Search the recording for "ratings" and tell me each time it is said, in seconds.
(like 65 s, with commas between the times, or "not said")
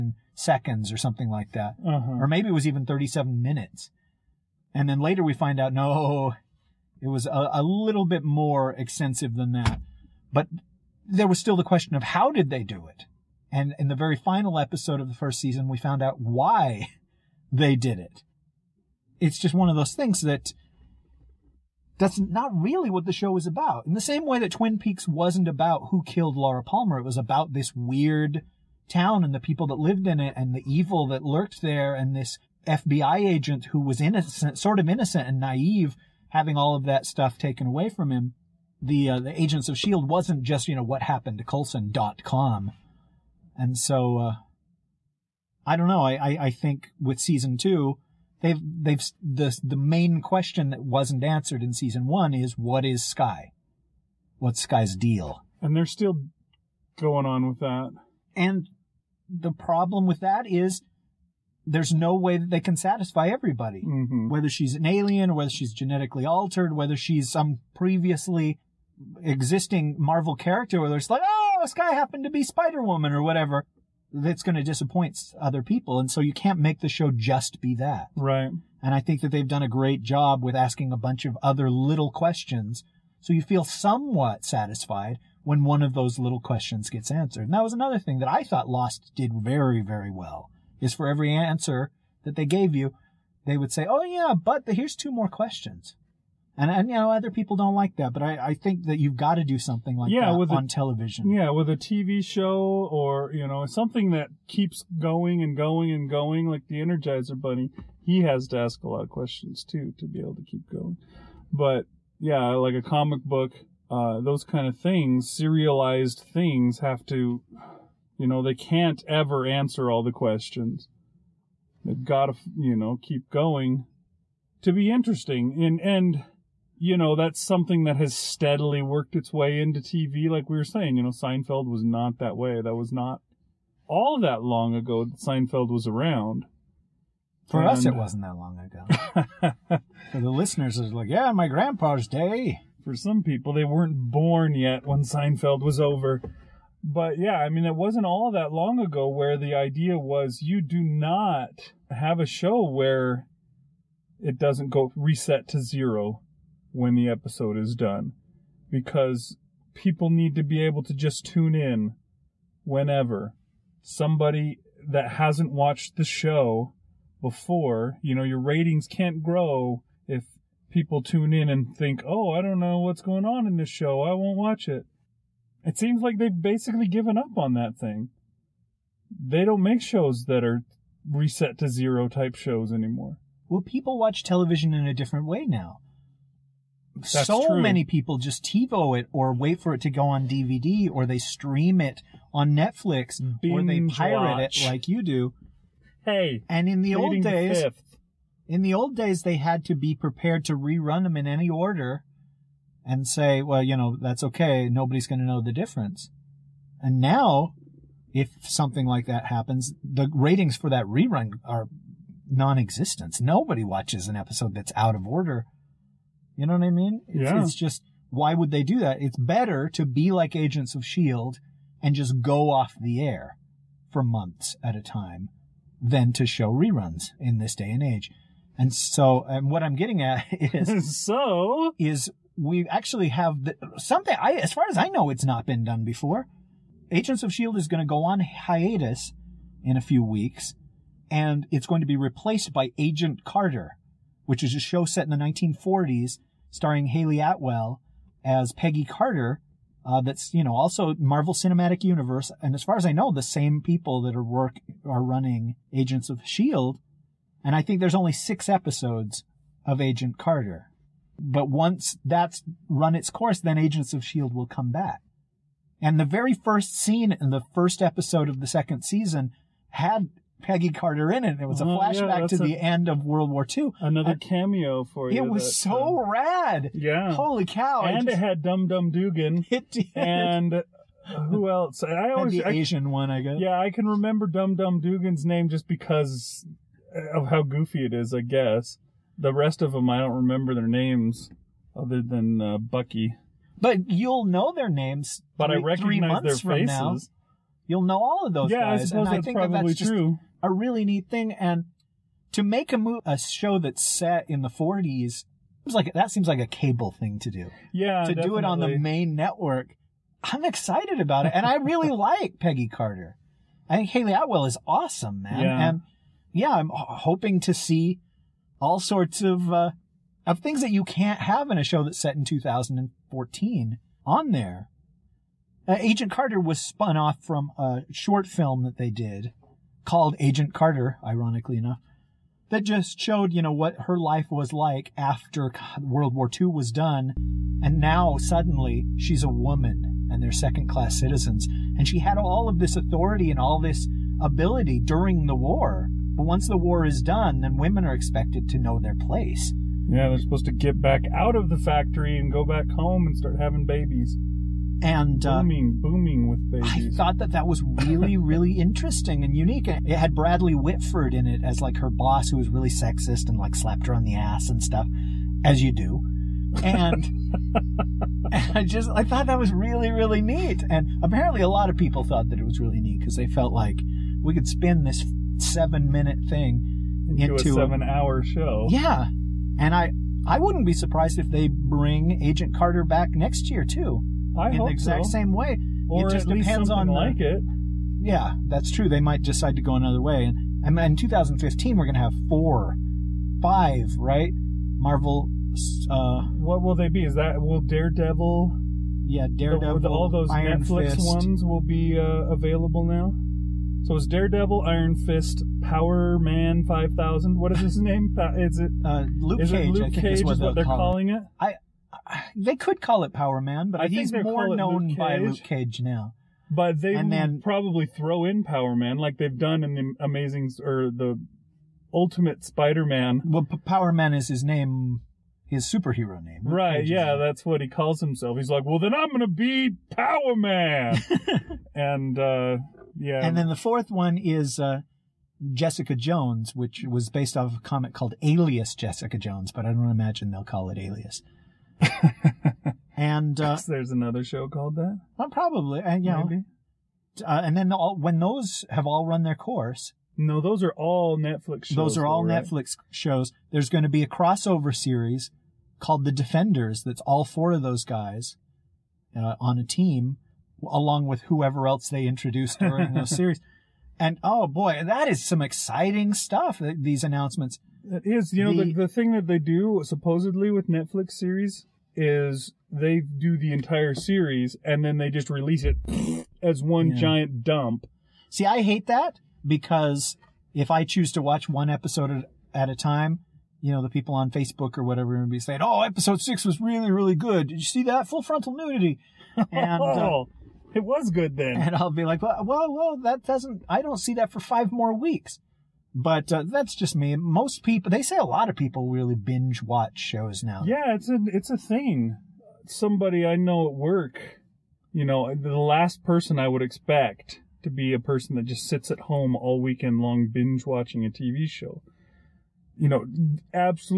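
168 s, 210 s.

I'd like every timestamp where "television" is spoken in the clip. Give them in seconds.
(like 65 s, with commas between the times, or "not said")
100 s, 184 s.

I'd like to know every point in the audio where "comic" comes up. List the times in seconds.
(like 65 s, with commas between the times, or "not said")
112 s, 437 s.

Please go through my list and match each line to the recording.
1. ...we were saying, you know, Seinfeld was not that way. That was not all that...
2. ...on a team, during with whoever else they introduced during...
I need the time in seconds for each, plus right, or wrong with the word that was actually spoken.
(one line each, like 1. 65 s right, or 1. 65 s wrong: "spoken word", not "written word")
1. 130 s right
2. 459 s wrong: "along", not "during".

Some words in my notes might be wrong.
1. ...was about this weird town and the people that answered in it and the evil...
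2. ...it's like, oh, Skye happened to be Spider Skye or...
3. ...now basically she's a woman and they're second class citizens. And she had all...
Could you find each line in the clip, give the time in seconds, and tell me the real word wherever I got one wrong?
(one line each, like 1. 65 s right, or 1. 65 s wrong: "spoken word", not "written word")
1. 27 s wrong: "lived", not "answered"
2. 70 s wrong: "Woman", not "Skye"
3. 337 s wrong: "suddenly", not "basically".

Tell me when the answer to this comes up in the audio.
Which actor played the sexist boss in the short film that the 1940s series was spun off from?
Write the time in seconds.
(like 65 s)
360 s.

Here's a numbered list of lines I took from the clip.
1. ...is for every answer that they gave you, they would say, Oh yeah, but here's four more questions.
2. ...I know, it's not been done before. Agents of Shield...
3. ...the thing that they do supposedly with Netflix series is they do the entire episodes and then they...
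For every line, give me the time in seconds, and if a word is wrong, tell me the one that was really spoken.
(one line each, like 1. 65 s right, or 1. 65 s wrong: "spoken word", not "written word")
1. 90 s wrong: "two", not "four"
2. 234 s right
3. 468 s wrong: "series", not "episodes".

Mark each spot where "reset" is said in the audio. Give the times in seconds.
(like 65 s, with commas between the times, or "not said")
154 s, 181 s.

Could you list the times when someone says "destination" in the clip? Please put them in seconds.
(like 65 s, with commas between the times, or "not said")
not said.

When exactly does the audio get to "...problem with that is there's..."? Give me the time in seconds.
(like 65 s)
59 s.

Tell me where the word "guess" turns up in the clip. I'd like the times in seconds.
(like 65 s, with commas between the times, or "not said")
283 s, 288 s.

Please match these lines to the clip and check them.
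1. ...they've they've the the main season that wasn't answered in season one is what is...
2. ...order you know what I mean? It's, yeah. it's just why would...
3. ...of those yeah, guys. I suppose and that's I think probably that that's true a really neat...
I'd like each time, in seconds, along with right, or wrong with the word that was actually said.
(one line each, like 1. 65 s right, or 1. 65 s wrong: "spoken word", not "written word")
1. 48 s wrong: "question", not "season"
2. 215 s right
3. 298 s right.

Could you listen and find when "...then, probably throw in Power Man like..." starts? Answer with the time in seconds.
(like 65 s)
417 s.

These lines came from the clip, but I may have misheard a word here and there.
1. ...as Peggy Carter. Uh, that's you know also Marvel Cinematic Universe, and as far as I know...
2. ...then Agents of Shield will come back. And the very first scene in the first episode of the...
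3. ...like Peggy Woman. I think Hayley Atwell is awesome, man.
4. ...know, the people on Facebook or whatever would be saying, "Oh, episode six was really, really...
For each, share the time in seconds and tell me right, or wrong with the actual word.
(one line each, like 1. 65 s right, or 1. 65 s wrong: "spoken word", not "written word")
1. 248 s right
2. 263 s right
3. 311 s wrong: "Carter", not "Woman"
4. 483 s right.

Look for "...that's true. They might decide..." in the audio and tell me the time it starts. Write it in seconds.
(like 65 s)
388 s.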